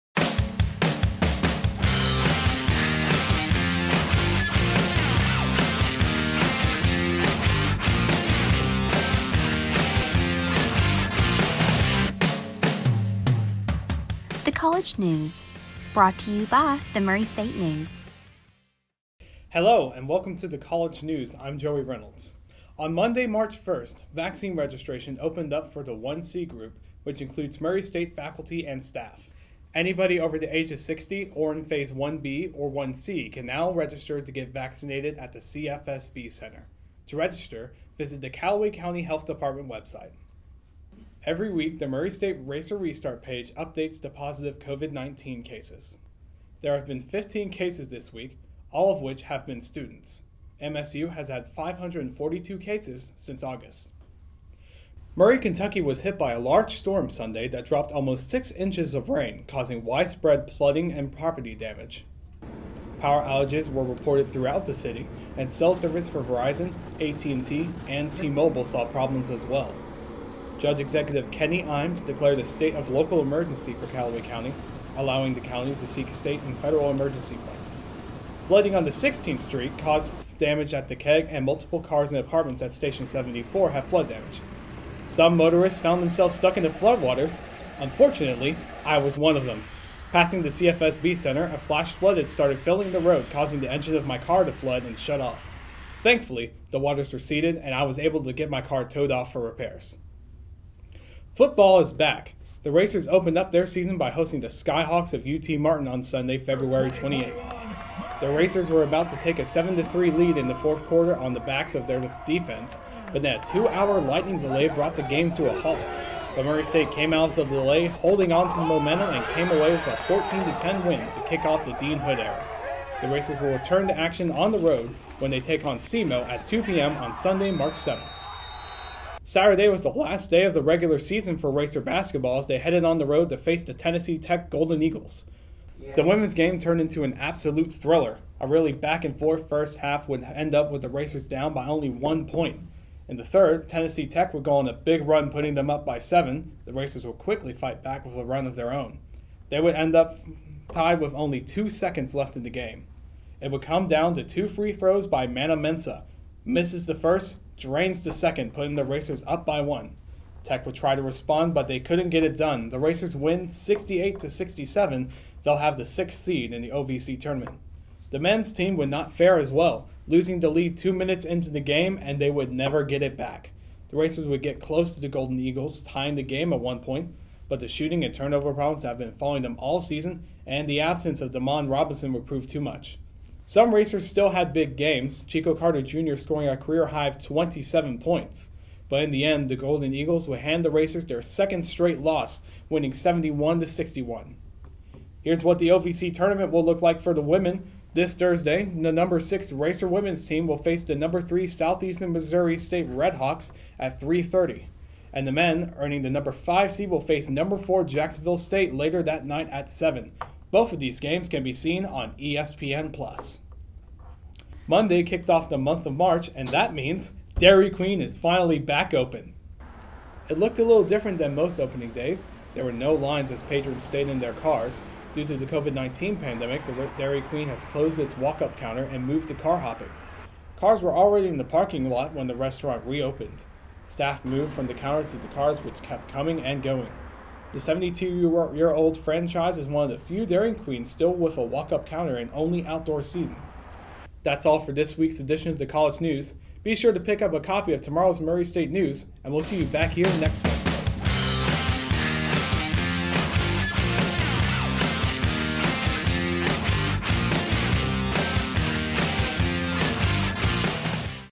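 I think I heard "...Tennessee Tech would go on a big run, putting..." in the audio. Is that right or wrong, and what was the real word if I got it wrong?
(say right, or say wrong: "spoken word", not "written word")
right.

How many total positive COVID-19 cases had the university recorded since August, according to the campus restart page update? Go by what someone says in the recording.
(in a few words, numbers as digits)
542.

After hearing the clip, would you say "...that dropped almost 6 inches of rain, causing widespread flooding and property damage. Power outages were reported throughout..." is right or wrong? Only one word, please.
right.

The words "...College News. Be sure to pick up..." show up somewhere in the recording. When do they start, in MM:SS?
04:05.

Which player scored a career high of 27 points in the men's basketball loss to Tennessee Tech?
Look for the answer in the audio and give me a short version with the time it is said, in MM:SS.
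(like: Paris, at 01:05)
Chico Carter Jr., at 03:05.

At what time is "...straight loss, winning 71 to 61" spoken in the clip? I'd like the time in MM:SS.
03:11.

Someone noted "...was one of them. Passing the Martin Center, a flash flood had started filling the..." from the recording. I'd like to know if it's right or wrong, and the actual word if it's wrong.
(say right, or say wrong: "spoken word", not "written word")
wrong: "CFSB", not "Martin".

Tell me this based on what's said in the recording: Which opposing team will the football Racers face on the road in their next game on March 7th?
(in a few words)
SEMO.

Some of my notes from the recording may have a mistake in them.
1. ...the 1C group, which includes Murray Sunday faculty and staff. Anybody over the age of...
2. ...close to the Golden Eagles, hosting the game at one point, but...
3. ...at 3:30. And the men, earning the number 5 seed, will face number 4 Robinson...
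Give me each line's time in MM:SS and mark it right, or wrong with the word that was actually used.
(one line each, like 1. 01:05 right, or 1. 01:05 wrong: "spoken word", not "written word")
1. 00:25 wrong: "State", not "Sunday"
2. 02:54 wrong: "tying", not "hosting"
3. 03:23 wrong: "Jacksonville", not "Robinson".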